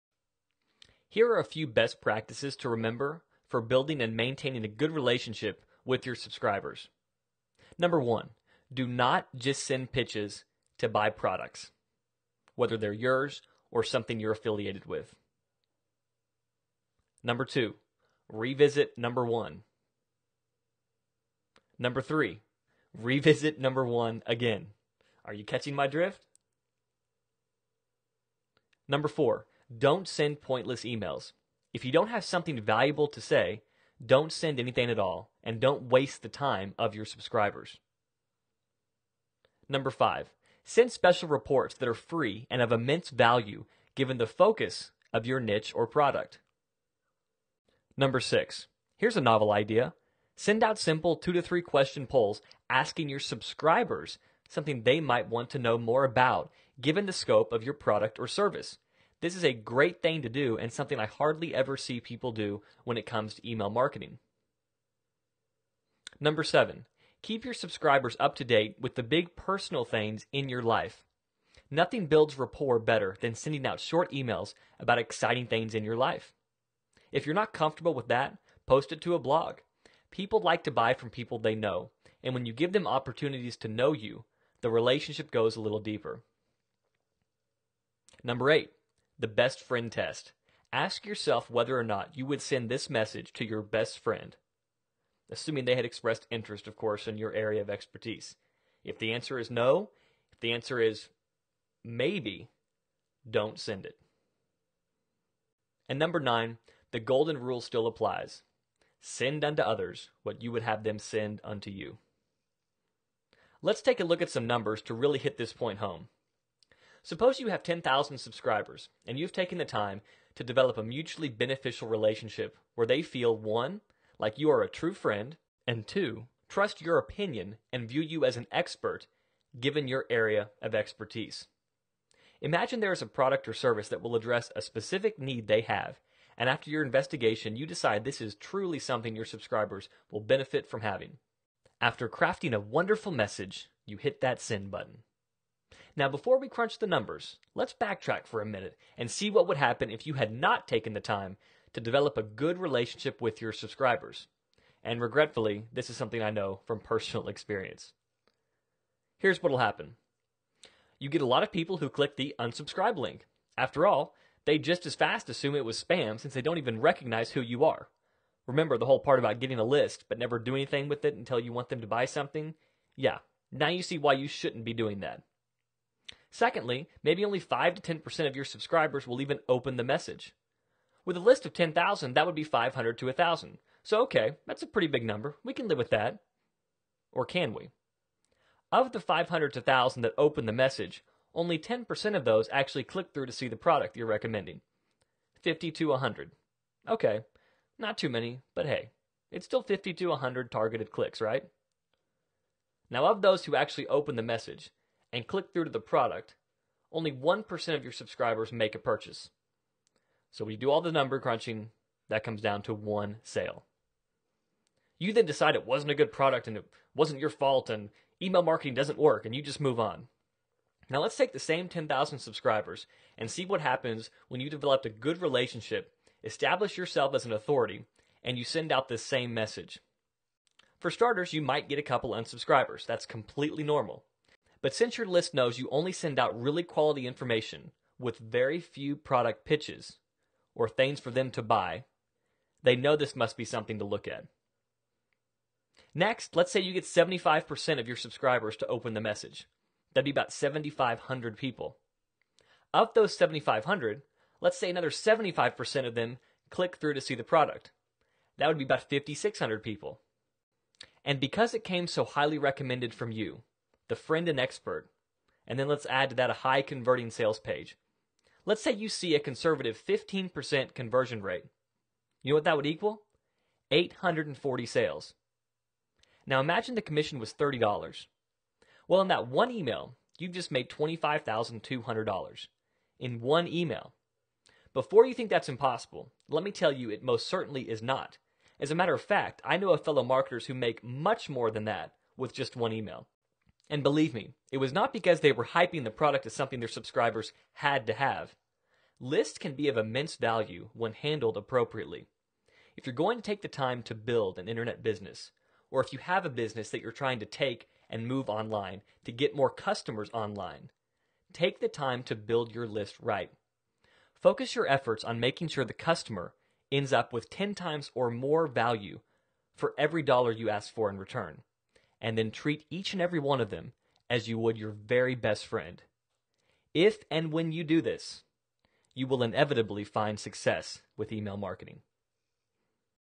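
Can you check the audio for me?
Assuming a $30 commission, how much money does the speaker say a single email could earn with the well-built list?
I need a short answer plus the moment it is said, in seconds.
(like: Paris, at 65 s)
$25,200, at 280 s.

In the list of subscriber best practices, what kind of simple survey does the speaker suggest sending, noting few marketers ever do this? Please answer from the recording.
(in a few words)
Two to three question polls.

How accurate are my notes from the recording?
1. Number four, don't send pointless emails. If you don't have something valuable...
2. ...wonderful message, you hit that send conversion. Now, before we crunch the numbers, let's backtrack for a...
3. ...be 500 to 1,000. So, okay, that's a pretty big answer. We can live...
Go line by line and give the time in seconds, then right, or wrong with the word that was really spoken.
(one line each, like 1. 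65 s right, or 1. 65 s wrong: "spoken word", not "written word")
1. 28 s right
2. 142 s wrong: "button", not "conversion"
3. 182 s wrong: "number", not "answer".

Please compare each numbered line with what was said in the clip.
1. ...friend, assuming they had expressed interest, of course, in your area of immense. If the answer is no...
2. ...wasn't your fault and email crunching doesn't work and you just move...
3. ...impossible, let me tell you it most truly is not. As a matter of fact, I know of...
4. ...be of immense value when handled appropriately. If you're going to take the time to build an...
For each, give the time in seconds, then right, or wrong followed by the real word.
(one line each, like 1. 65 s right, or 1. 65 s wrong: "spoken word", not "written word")
1. 93 s wrong: "expertise", not "immense"
2. 216 s wrong: "marketing", not "crunching"
3. 285 s wrong: "certainly", not "truly"
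4. 299 s right.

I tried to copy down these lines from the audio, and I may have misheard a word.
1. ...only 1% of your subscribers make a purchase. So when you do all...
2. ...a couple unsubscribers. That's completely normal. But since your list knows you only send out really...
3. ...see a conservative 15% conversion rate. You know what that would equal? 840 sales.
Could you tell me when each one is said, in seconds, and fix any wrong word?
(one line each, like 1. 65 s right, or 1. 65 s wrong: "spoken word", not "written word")
1. 206 s right
2. 231 s right
3. 268 s right.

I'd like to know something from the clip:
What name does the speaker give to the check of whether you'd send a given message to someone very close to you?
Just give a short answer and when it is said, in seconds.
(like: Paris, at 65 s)
The best friend test, at 89 s.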